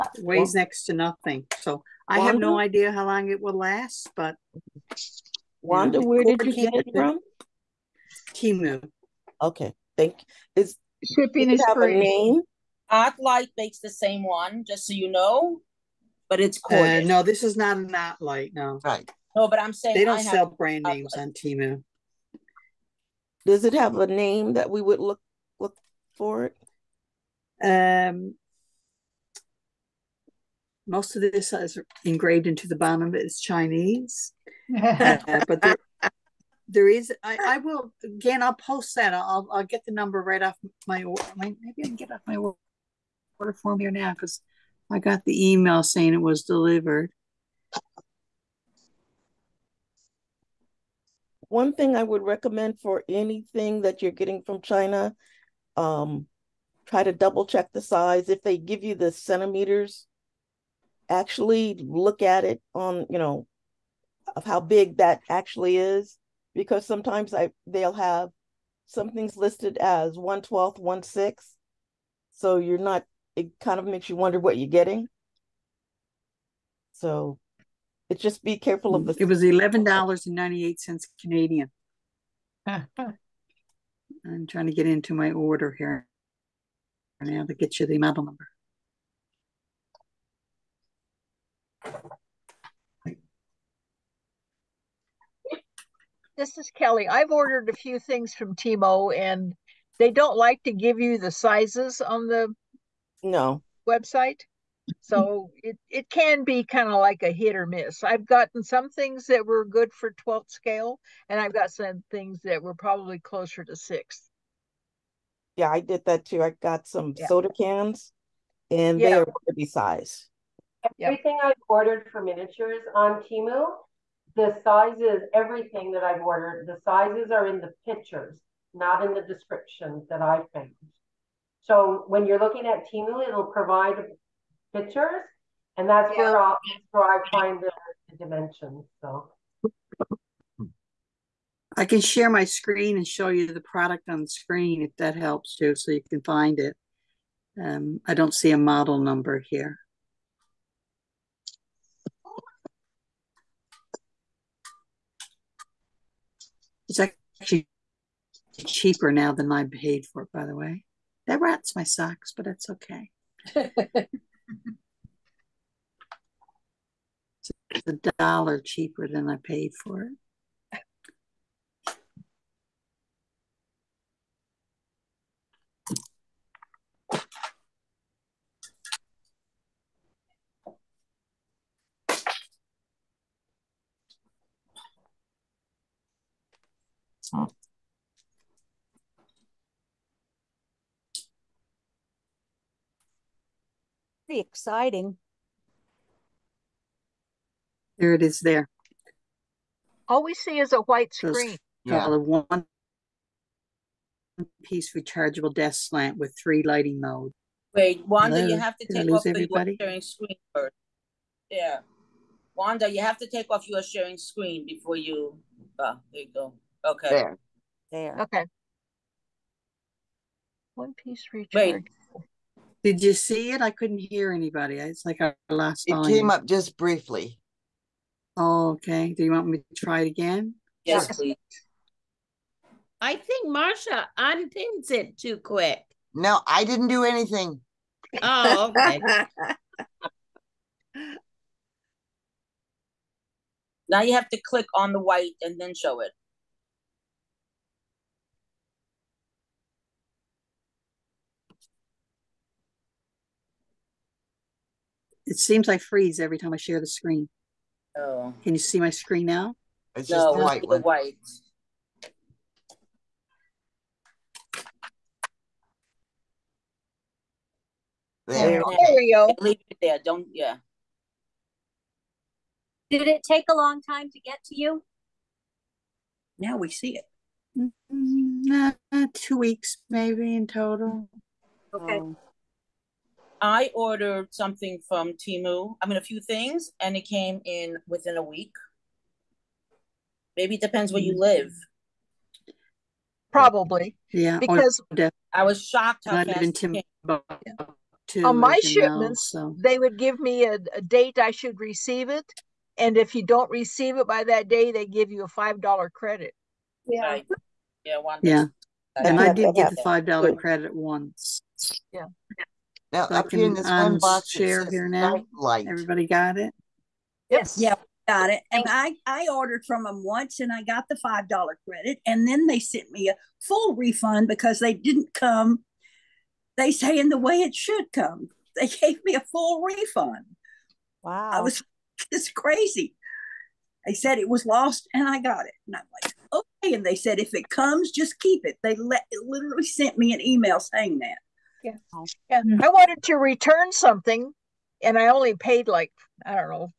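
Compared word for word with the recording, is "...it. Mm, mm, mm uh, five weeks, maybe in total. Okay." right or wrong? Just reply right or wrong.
wrong.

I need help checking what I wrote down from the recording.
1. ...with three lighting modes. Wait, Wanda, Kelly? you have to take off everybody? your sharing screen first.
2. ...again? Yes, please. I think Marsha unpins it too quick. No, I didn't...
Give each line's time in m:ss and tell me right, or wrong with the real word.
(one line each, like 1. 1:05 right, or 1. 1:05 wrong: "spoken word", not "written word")
1. 3:26 wrong: "Hello", not "Kelly"
2. 3:50 right.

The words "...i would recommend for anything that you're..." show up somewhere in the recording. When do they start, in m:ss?
0:51.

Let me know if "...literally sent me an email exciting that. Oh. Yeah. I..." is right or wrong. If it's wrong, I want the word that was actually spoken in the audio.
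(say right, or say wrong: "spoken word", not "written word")
wrong: "saying", not "exciting".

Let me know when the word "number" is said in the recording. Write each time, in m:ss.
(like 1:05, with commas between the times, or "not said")
0:39, 1:28, 2:28.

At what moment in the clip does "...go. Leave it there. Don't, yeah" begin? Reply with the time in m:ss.
4:29.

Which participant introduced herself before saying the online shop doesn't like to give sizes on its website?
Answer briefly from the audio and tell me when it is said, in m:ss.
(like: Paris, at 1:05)
Kelly, at 1:36.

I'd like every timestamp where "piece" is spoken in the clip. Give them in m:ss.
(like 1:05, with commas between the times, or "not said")
3:24, 3:40.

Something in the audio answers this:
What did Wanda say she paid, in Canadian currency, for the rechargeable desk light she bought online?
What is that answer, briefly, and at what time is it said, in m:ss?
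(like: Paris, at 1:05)
$11.98, at 1:19.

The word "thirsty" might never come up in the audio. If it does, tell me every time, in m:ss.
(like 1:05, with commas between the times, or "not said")
not said.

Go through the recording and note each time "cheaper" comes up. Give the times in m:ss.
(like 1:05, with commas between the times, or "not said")
2:38, 2:48.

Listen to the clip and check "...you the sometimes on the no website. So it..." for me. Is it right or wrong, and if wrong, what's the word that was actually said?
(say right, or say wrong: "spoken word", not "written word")
wrong: "sizes", not "sometimes".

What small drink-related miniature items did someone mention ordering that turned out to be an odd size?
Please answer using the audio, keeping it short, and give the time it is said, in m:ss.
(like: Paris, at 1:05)
soda cans, at 1:57.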